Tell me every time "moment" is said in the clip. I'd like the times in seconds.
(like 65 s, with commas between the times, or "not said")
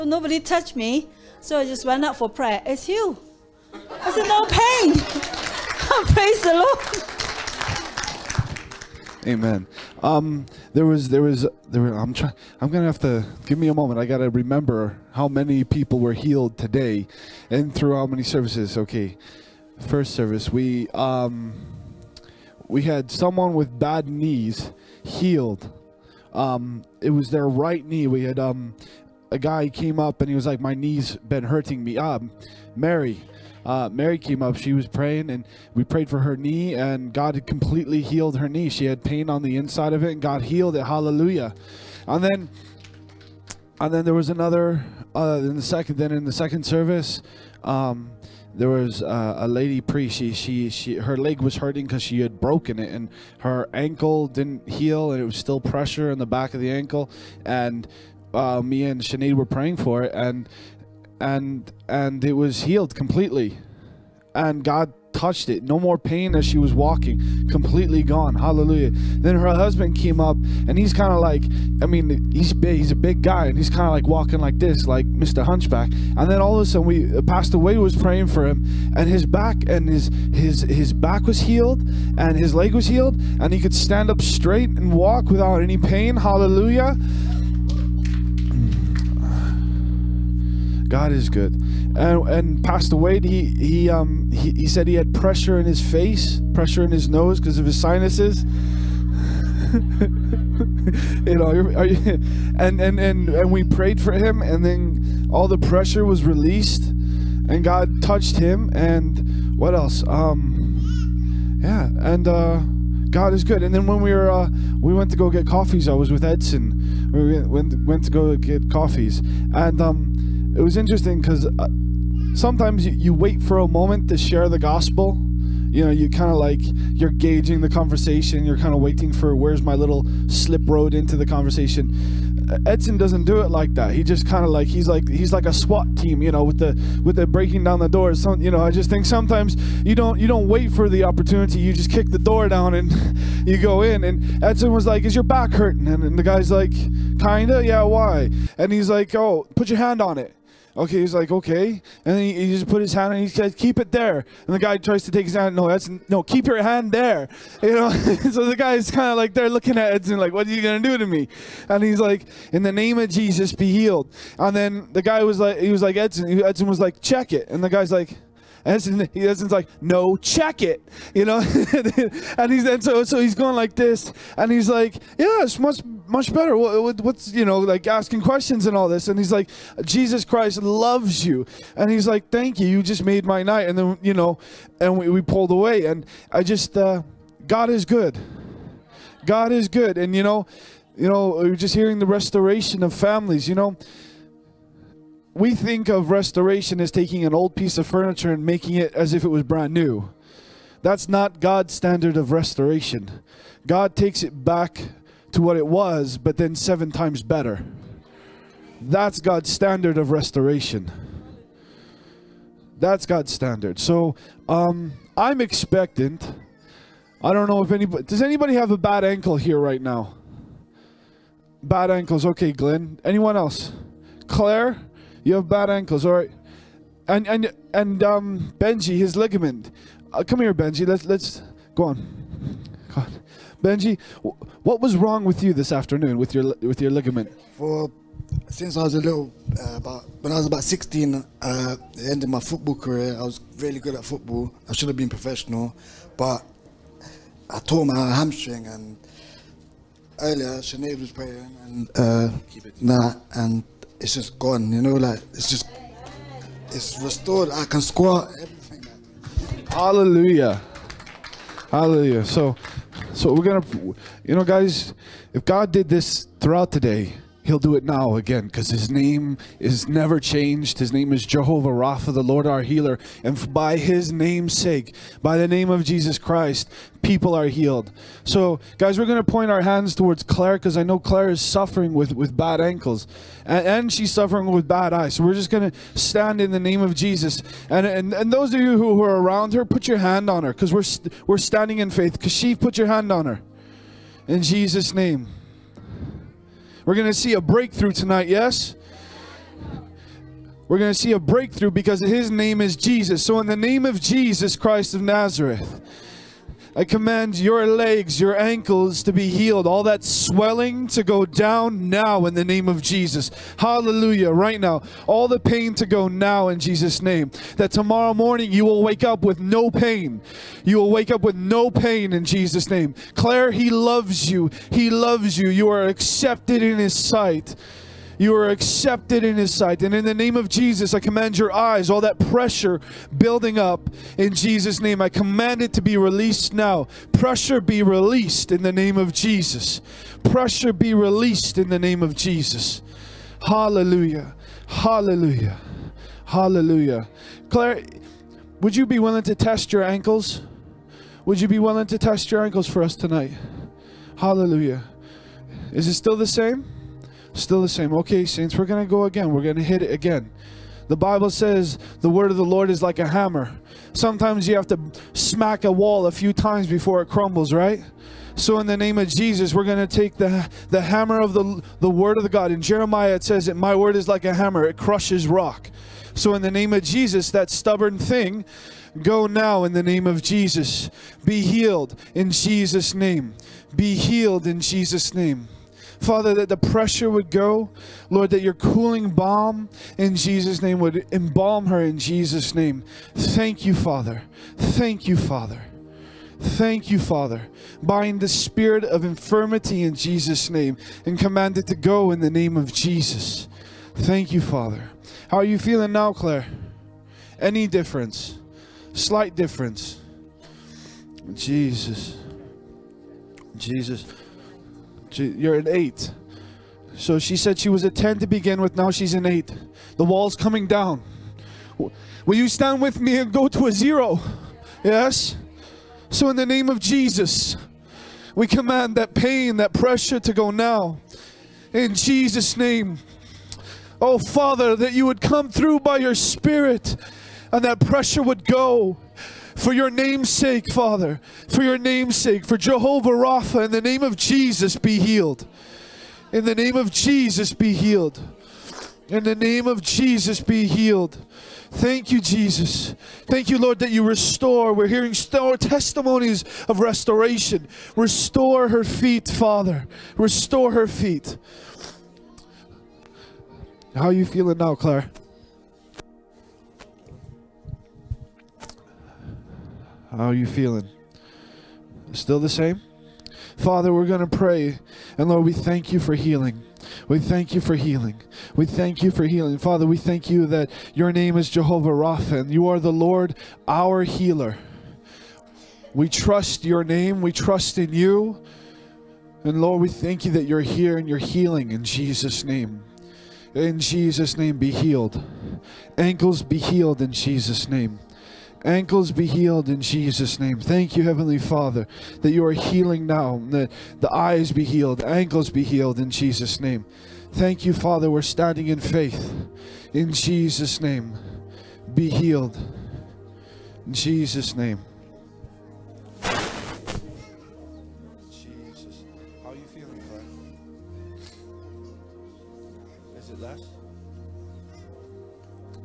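13 s, 123 s.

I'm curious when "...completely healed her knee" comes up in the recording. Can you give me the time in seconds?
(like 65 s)
37 s.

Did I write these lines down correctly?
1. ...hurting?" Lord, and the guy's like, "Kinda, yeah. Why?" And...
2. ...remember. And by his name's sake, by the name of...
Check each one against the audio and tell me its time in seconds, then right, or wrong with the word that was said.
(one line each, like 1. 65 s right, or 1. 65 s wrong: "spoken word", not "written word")
1. 145 s wrong: "And", not "Lord"
2. 272 s wrong: "healer", not "remember".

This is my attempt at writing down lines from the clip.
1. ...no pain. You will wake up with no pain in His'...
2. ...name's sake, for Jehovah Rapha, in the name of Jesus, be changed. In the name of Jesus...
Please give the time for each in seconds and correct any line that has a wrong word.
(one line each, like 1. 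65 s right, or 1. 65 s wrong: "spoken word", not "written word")
1. 319 s wrong: "Jesus", not "His"
2. 441 s wrong: "healed", not "changed".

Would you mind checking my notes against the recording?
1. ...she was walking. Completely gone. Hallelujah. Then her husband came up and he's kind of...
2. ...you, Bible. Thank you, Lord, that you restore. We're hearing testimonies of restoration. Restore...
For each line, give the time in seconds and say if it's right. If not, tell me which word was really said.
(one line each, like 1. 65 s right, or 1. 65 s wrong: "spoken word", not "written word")
1. 66 s right
2. 452 s wrong: "Jesus", not "Bible".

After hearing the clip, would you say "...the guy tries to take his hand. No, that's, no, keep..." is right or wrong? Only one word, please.
right.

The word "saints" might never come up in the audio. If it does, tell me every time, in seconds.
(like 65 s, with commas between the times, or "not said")
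358 s.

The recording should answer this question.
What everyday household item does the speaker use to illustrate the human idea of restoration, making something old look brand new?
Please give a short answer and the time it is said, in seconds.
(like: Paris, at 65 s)
Furniture, at 197 s.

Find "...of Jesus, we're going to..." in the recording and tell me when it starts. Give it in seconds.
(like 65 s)
368 s.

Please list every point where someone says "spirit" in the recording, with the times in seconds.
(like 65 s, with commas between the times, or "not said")
398 s, 436 s.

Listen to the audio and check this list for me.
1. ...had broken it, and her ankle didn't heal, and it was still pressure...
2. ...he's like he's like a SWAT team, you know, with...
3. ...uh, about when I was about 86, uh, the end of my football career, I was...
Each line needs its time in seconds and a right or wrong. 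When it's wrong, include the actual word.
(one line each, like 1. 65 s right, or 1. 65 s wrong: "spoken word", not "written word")
1. 52 s right
2. 134 s right
3. 239 s wrong: "16", not "86".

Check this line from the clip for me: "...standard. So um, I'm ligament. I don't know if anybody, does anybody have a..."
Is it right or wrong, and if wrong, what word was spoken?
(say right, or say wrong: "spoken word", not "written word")
wrong: "expectant", not "ligament".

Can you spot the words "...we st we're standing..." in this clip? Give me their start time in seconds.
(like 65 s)
290 s.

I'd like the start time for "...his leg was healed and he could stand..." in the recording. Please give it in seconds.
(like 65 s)
82 s.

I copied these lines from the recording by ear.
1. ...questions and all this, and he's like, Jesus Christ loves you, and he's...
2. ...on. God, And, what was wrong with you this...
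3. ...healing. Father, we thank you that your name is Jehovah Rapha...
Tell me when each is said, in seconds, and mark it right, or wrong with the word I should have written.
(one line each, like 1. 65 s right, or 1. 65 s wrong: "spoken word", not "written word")
1. 178 s right
2. 231 s wrong: "Benji", not "And"
3. 479 s right.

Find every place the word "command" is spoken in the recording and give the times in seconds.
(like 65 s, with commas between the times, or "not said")
306 s, 330 s, 335 s, 401 s, 428 s.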